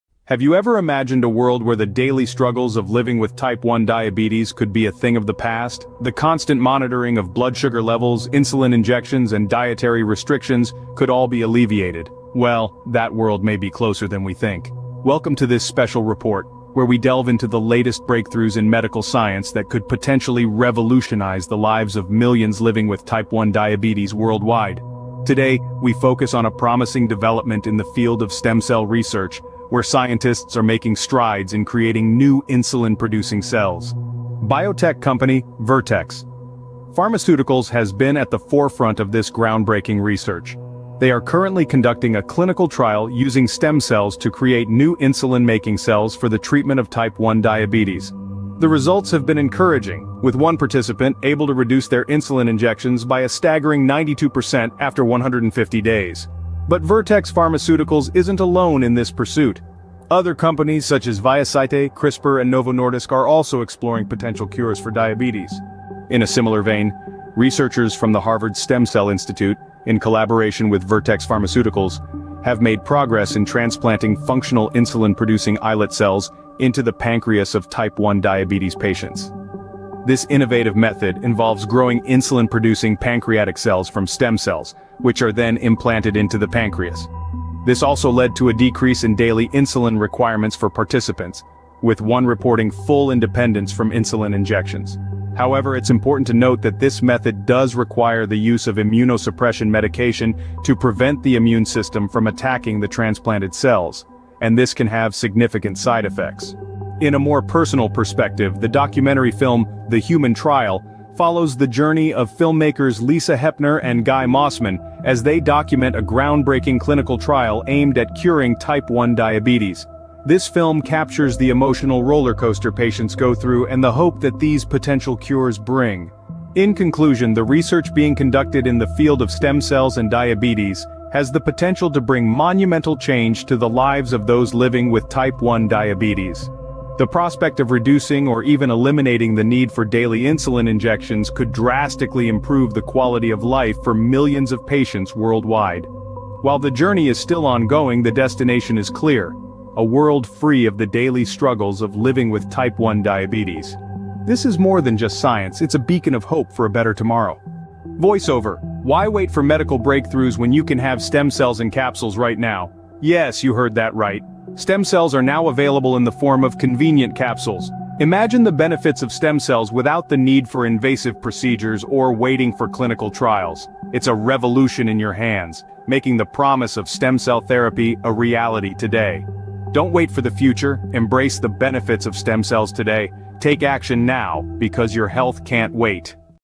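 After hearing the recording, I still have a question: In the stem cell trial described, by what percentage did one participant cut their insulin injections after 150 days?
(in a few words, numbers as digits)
92%.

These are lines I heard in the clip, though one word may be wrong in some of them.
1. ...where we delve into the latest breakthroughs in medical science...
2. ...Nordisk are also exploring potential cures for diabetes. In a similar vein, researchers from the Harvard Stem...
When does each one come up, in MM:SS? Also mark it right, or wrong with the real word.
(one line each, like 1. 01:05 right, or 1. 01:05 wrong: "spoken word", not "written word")
1. 00:16 right
2. 01:02 right.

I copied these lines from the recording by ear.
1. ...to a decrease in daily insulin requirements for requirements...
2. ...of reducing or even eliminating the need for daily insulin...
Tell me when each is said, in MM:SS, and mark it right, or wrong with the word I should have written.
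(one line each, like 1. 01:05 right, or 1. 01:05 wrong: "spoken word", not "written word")
1. 01:28 wrong: "participants", not "requirements"
2. 02:17 right.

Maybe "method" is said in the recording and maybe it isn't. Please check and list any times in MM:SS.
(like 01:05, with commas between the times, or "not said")
01:20, 01:37.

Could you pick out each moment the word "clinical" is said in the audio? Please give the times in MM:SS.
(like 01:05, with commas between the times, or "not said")
00:42, 01:56, 02:52.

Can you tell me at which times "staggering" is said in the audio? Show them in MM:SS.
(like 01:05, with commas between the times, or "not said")
00:53.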